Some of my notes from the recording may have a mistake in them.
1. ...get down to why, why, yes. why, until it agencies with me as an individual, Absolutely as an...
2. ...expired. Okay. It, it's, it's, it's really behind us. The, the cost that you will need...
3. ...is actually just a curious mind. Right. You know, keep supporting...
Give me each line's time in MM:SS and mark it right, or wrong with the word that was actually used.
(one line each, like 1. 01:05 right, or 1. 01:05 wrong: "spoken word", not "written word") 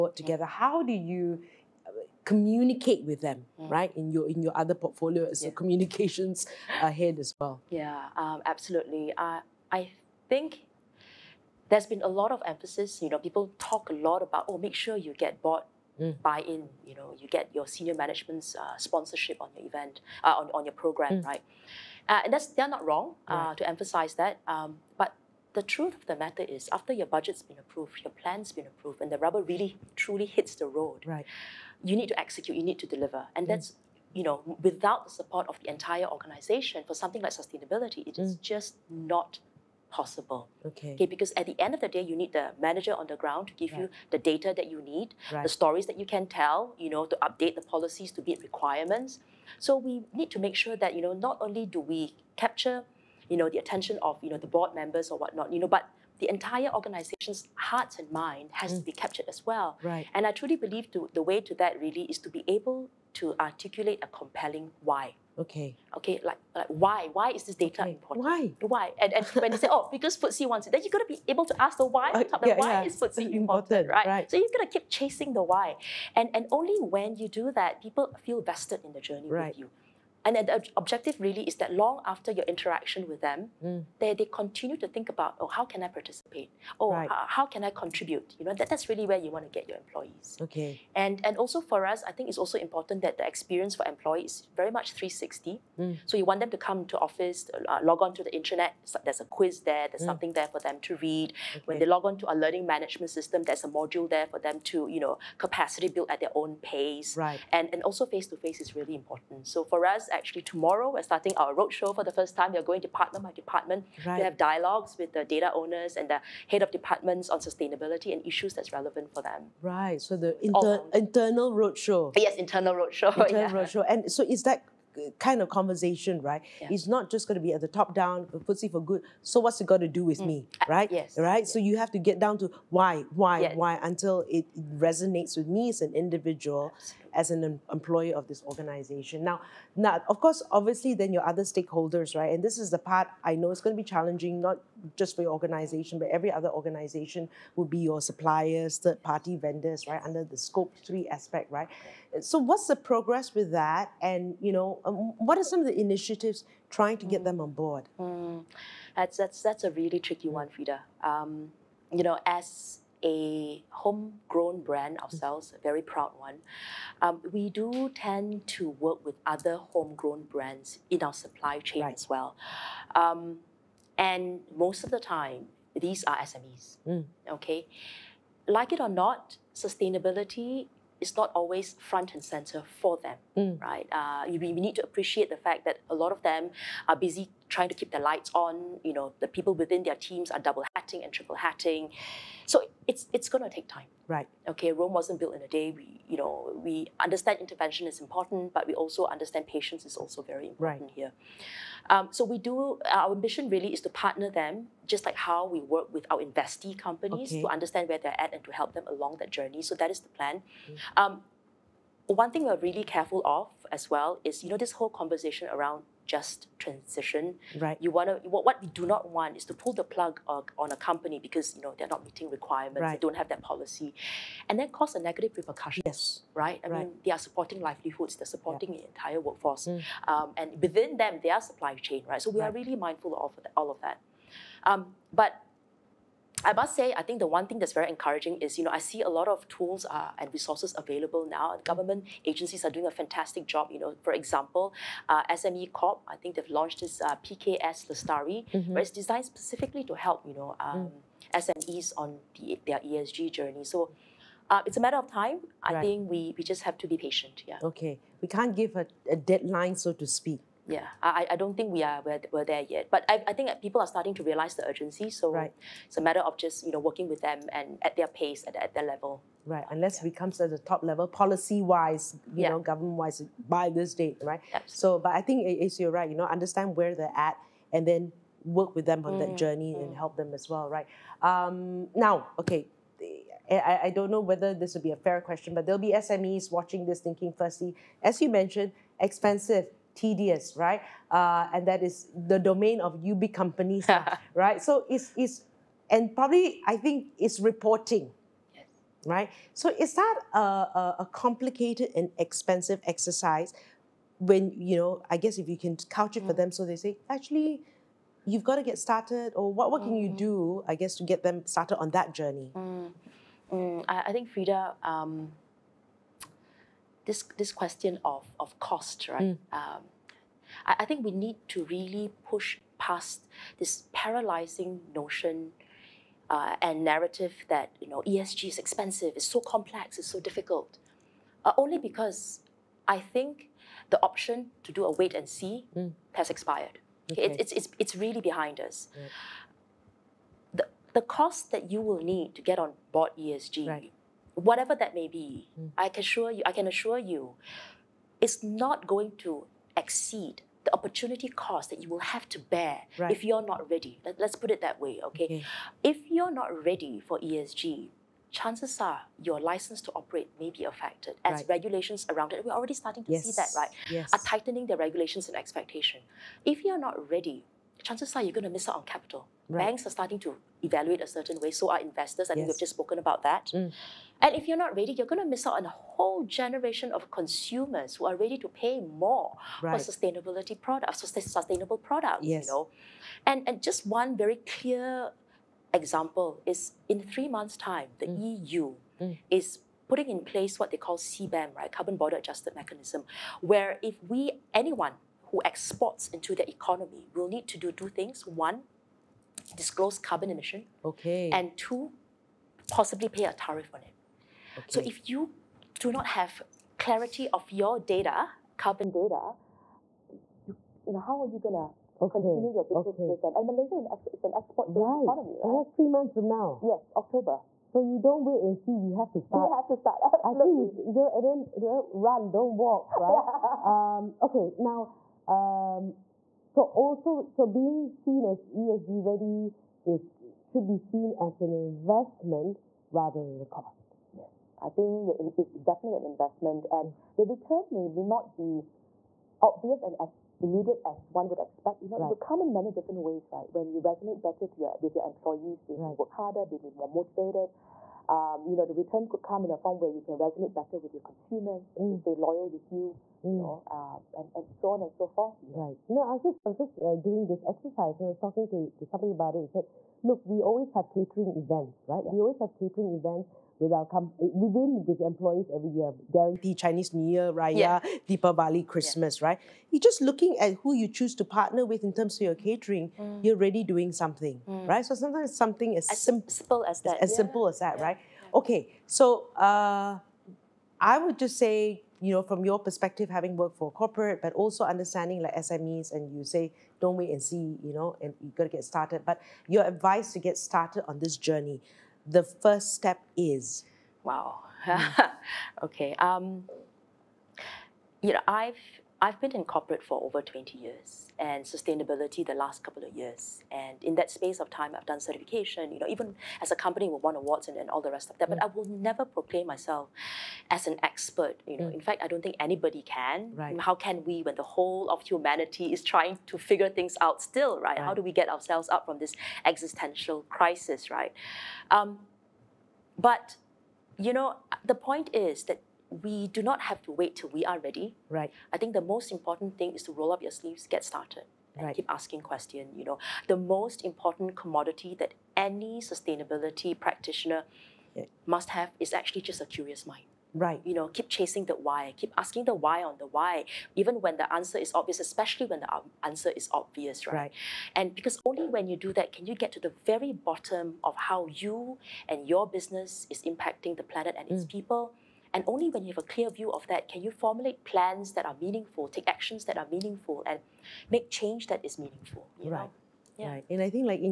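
1. 02:11 wrong: "resonates", not "agencies"
2. 05:36 right
3. 08:58 wrong: "chasing", not "supporting".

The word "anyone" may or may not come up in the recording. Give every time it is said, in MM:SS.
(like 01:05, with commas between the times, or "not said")
06:34.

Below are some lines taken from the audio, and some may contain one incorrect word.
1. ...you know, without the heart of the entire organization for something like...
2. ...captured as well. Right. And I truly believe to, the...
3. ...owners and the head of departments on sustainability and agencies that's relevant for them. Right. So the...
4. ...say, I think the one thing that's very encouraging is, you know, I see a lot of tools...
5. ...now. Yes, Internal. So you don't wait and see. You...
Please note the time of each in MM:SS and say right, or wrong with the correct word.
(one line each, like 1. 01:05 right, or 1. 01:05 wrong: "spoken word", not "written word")
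1. 00:34 wrong: "support", not "heart"
2. 00:58 right
3. 01:55 wrong: "issues", not "agencies"
4. 03:56 right
5. 06:56 wrong: "October", not "Internal".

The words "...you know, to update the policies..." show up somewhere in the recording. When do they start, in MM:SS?
00:46.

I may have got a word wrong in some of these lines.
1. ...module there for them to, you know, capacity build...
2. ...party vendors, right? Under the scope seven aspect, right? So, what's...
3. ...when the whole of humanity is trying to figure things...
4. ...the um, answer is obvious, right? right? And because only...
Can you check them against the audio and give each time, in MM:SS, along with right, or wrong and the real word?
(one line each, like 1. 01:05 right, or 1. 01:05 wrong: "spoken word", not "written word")
1. 01:43 right
2. 02:29 wrong: "three", not "seven"
3. 08:34 right
4. 09:05 right.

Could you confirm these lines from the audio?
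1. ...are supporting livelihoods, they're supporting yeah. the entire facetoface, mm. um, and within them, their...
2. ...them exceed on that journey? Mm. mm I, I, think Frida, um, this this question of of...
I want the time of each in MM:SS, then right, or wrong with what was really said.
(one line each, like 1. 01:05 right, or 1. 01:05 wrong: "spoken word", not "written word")
1. 03:47 wrong: "workforce", not "facetoface"
2. 05:11 wrong: "started", not "exceed".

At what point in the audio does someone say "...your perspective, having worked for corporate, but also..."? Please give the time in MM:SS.
08:02.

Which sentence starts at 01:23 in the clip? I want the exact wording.
they, they continue to think about, oh, how can I participate?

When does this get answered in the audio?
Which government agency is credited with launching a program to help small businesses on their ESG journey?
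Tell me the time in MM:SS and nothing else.
04:05.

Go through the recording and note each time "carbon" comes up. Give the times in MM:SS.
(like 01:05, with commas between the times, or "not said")
06:31, 06:39, 06:48.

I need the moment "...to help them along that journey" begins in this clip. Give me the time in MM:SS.
03:28.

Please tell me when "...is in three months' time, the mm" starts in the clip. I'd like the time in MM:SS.
06:26.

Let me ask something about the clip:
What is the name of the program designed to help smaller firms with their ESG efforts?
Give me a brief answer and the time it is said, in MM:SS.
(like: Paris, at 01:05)
PKS Lestari, at 04:07.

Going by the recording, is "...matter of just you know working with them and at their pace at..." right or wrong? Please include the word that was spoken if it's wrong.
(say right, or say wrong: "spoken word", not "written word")
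right.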